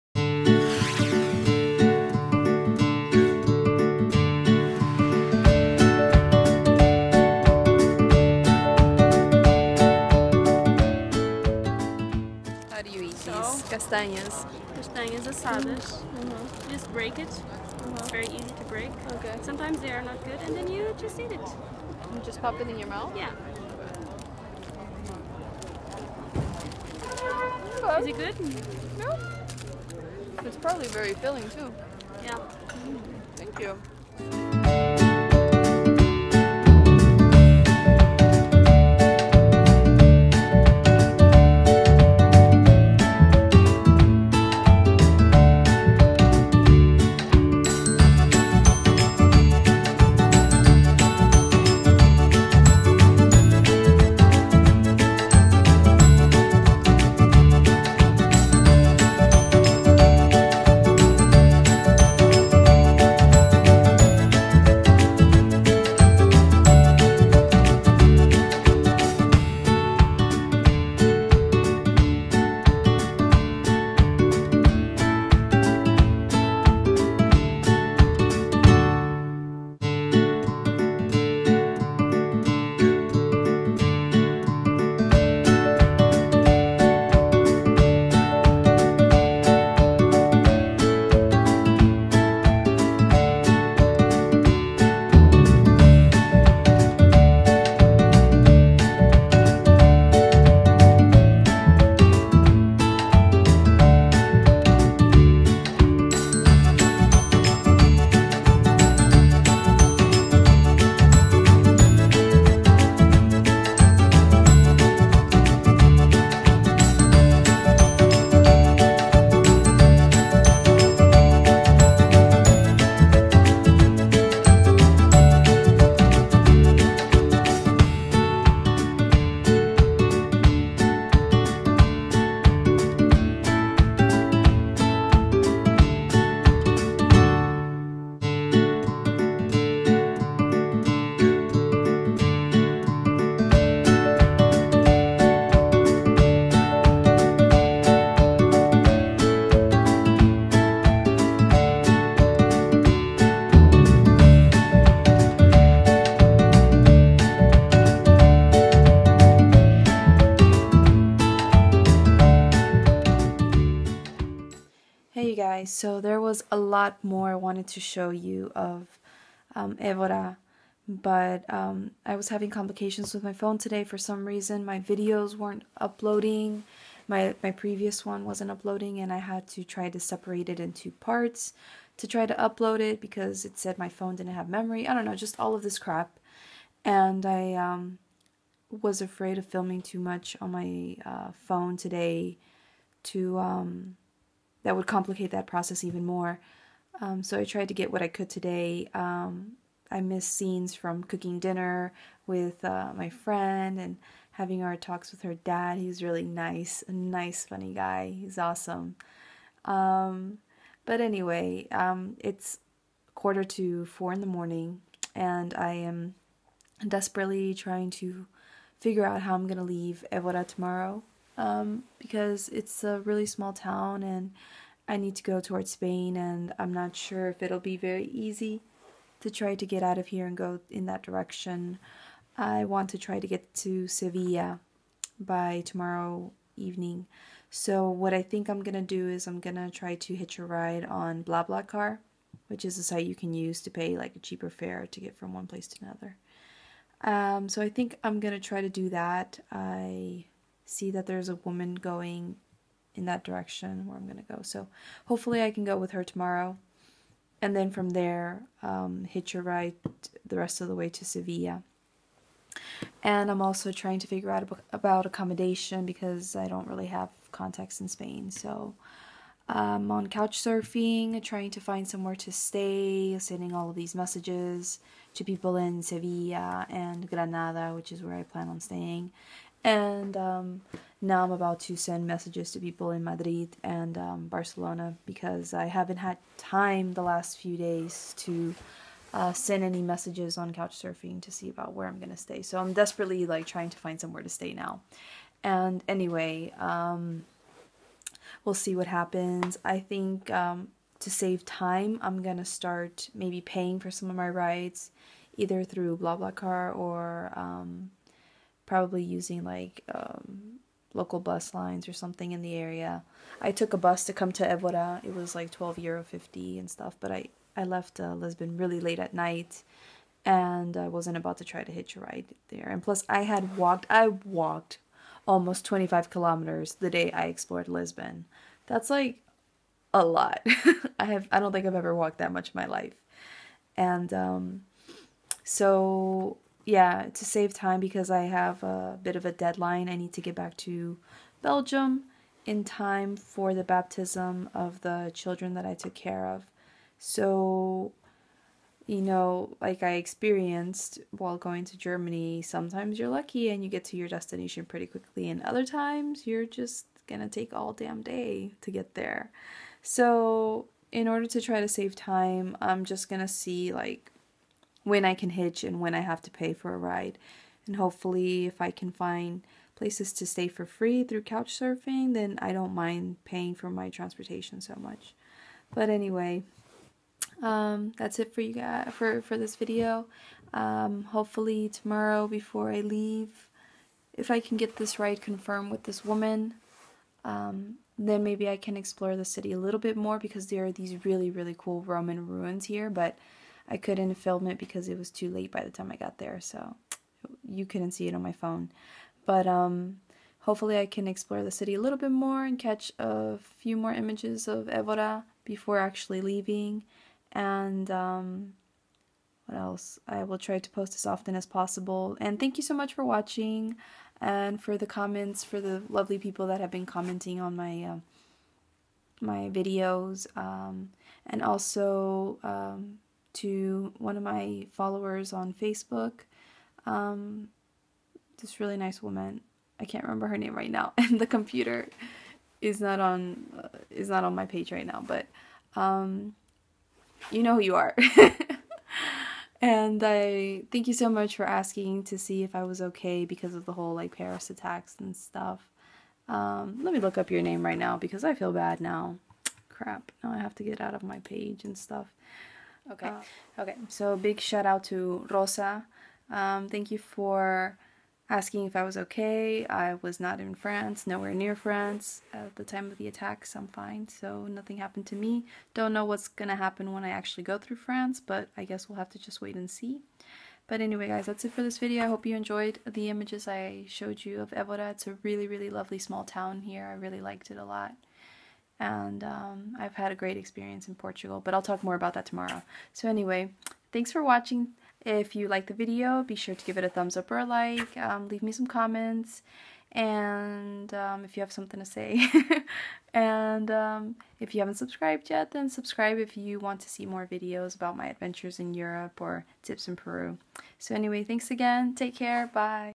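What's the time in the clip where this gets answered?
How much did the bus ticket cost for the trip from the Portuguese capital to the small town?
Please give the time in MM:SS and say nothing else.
05:15.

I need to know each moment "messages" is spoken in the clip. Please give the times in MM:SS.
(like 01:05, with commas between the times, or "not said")
04:33, 04:42, 04:49.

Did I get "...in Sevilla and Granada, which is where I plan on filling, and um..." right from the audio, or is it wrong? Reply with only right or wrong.
wrong.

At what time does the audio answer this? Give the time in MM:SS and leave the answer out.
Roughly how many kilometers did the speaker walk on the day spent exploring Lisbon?
05:25.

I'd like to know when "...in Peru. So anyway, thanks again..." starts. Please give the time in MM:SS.
08:19.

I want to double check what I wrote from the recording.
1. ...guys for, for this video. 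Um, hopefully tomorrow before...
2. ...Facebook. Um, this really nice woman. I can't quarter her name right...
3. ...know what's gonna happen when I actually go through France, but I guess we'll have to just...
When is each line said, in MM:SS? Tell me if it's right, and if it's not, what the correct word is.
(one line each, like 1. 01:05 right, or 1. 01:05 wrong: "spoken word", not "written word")
1. 06:18 right
2. 07:05 wrong: "remember", not "quarter"
3. 07:45 right.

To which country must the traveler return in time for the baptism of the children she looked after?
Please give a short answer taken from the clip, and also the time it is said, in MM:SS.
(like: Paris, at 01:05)
Belgium, at 05:41.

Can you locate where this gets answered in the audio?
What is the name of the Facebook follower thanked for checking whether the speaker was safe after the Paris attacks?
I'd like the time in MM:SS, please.
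07:35.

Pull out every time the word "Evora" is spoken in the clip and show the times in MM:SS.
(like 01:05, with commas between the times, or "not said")
02:49, 03:40, 05:14, 06:44.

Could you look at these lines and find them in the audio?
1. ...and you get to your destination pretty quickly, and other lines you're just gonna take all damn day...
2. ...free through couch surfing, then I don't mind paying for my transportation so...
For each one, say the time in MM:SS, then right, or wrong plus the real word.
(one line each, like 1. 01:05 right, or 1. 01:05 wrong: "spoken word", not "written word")
1. 05:53 wrong: "times", not "lines"
2. 06:10 right.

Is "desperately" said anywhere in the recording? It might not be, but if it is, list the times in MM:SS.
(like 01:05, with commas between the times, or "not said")
03:36, 04:52.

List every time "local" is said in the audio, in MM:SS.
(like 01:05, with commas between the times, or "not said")
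05:10.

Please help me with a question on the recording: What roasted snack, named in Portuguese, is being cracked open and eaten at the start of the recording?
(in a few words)
Castanhas assadas.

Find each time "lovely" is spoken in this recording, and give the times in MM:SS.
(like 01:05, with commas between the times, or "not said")
06:55, 07:55.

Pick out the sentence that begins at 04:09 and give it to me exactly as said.
I see that there's a woman going in that direction where I'm going to go.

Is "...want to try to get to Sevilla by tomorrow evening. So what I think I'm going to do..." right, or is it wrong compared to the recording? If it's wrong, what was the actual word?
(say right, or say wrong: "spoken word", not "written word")
right.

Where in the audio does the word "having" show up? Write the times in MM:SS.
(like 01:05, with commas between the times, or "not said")
02:52, 03:24.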